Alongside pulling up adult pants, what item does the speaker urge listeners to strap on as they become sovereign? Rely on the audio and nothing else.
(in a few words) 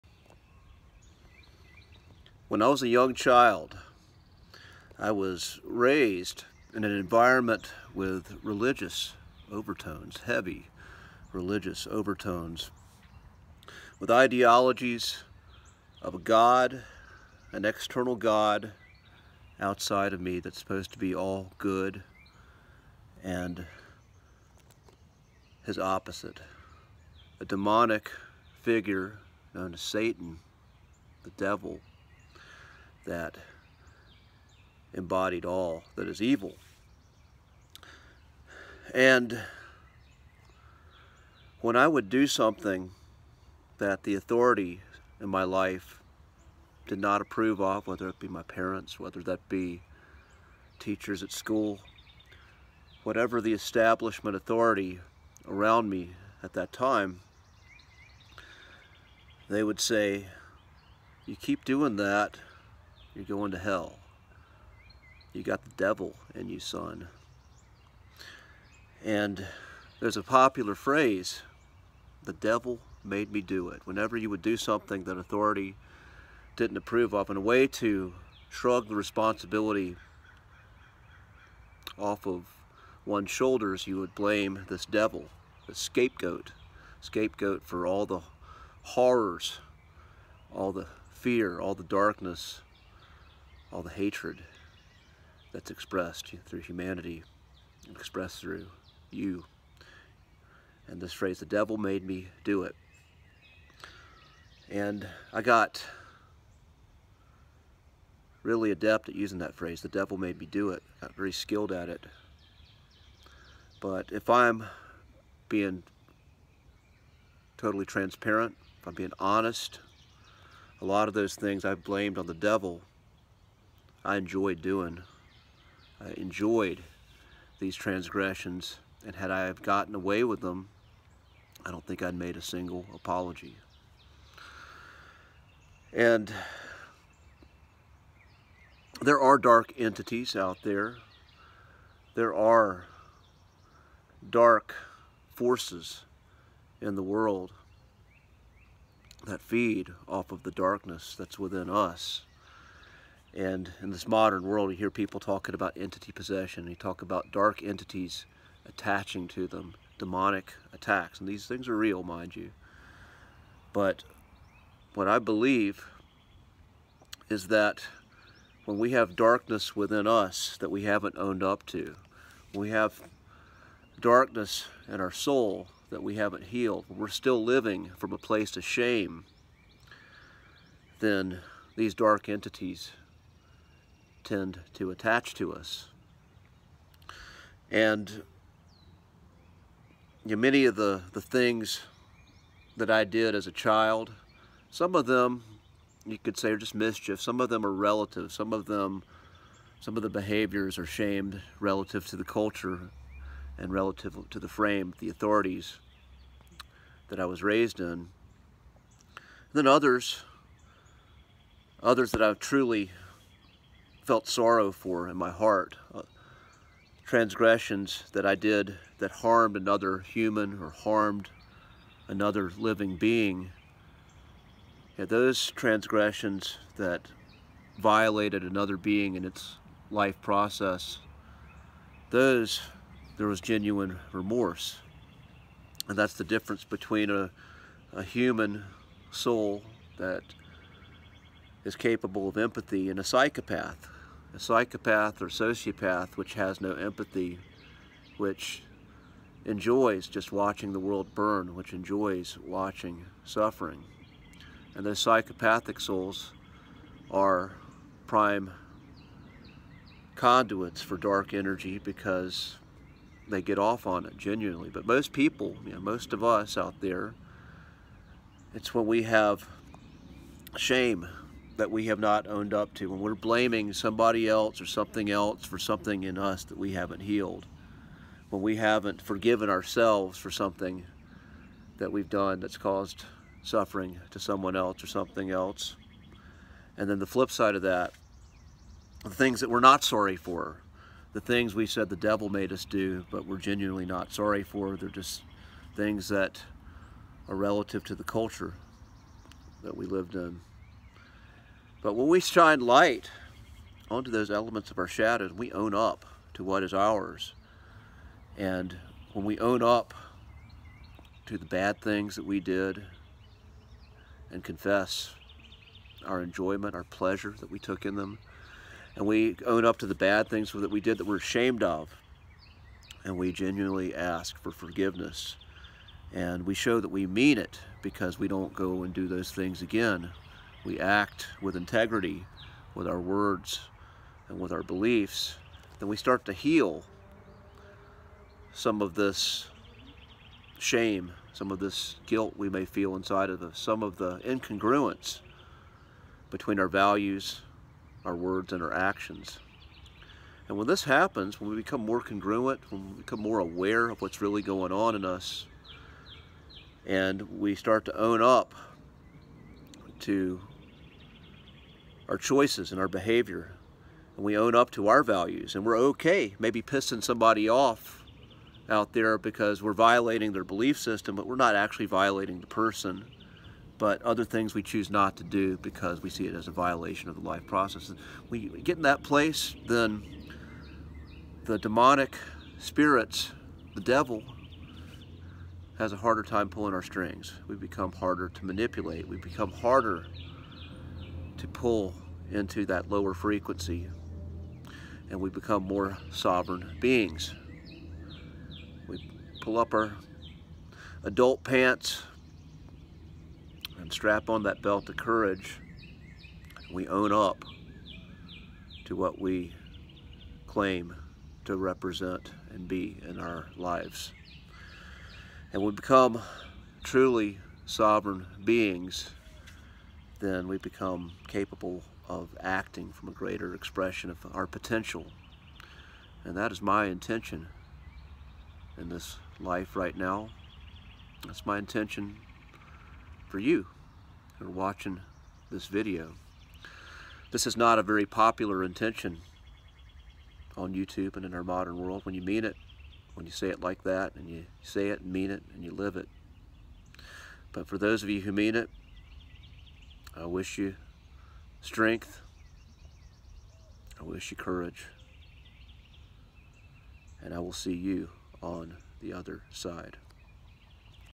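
belt of courage.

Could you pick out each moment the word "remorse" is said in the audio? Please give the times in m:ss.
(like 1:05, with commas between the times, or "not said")
3:54.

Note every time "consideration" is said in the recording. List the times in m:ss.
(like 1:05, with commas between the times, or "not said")
not said.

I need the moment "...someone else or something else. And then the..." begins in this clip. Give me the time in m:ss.
4:44.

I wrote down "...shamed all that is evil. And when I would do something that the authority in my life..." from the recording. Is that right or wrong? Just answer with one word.
wrong.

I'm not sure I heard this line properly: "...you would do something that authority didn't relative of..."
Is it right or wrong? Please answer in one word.
wrong.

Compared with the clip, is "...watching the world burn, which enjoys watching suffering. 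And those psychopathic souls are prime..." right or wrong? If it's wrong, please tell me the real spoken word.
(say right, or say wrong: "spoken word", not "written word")
right.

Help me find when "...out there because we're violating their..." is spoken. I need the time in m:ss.
6:08.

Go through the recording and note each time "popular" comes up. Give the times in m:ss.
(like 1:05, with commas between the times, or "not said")
1:10, 7:18.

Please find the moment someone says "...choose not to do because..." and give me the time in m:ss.
6:14.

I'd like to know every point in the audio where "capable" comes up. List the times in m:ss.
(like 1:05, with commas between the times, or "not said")
4:01, 7:01.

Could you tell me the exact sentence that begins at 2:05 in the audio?
I enjoyed these transgressions, and had I have gotten away with them, I don't think I'd made a single apology.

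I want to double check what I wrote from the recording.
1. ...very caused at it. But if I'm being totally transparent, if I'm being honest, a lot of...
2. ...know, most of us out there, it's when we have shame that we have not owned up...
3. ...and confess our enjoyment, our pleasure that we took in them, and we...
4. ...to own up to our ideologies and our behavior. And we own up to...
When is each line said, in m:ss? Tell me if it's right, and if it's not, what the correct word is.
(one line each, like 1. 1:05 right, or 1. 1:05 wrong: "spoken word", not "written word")
1. 1:51 wrong: "skilled", not "caused"
2. 4:25 right
3. 5:14 right
4. 5:57 wrong: "choices", not "ideologies".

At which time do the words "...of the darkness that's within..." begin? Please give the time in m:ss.
2:30.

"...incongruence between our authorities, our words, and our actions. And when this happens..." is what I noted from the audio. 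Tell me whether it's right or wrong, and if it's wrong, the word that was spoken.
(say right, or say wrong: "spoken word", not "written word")
wrong: "values", not "authorities".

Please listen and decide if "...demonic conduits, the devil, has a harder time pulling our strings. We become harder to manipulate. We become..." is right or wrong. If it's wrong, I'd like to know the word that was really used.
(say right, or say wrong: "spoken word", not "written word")
wrong: "spirits", not "conduits".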